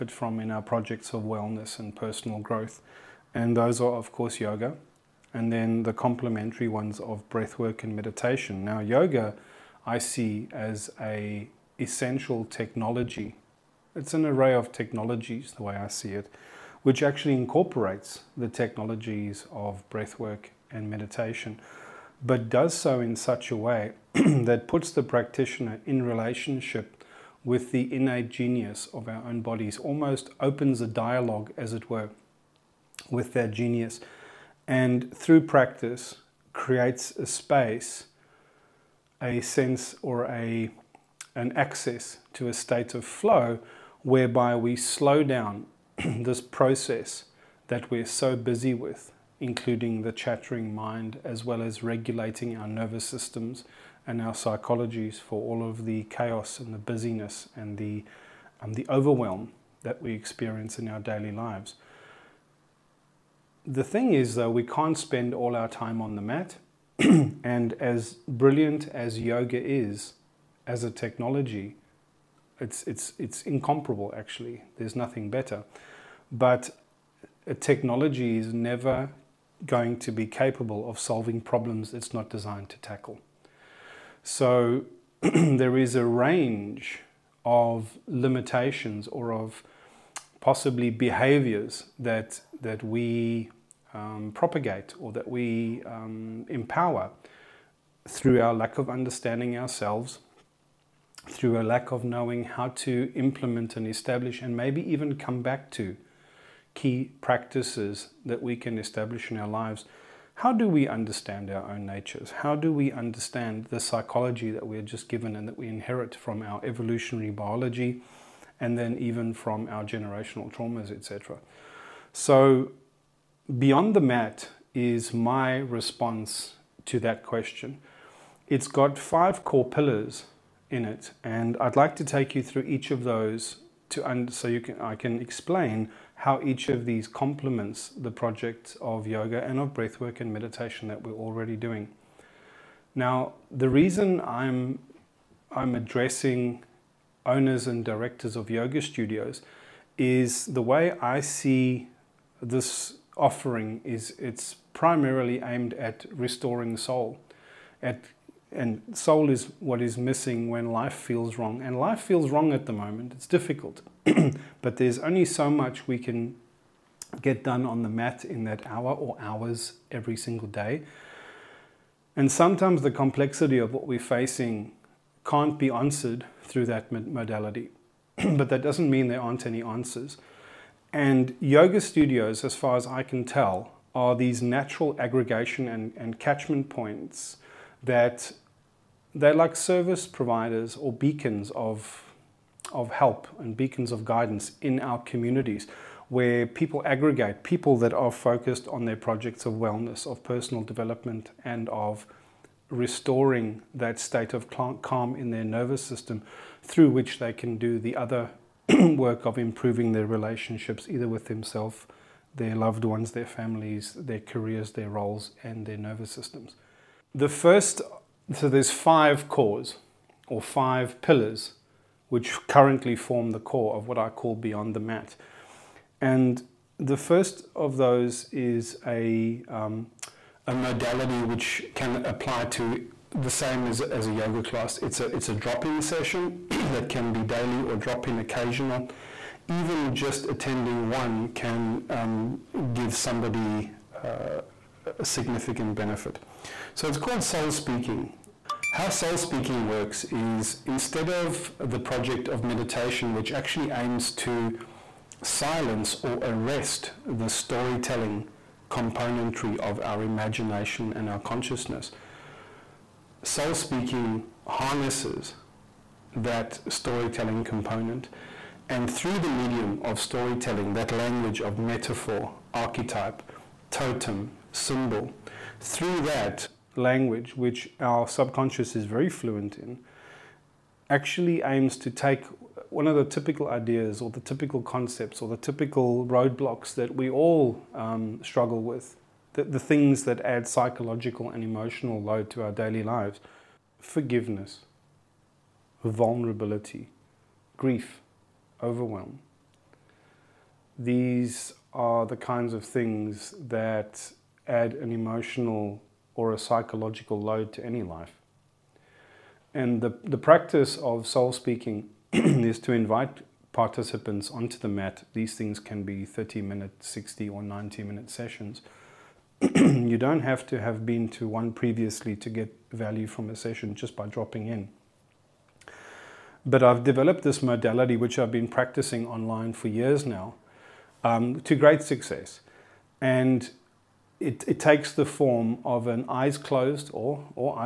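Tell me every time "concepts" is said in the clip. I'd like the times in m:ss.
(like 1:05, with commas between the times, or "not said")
4:44.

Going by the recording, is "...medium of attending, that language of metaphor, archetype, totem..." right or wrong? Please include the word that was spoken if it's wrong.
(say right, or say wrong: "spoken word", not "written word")
wrong: "storytelling", not "attending".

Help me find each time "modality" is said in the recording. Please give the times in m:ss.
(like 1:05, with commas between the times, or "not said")
2:56, 3:50, 5:27.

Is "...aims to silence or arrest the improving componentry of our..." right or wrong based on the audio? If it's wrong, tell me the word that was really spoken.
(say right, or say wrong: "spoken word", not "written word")
wrong: "storytelling", not "improving".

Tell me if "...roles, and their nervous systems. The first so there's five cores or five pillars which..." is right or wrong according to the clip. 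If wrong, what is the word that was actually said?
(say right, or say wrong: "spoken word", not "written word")
right.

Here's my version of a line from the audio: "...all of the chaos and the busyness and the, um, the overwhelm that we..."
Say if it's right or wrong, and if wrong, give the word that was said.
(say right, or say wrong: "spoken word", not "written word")
right.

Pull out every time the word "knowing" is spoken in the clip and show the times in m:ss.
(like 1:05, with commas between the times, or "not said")
1:42.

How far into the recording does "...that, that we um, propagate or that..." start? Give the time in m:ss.
1:31.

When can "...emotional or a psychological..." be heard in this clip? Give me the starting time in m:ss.
5:04.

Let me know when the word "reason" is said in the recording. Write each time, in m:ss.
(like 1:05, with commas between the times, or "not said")
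2:23.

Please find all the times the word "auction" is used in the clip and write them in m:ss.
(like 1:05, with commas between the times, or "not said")
not said.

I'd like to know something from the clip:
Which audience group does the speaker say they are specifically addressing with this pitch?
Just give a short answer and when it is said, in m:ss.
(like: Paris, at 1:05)
owners and directors of yoga studios, at 2:27.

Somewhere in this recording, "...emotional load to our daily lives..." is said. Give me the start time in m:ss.
4:51.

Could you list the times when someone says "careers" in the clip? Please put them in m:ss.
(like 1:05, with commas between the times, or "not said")
3:34.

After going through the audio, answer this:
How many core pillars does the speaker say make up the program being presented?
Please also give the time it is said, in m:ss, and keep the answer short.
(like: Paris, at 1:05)
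5, at 2:08.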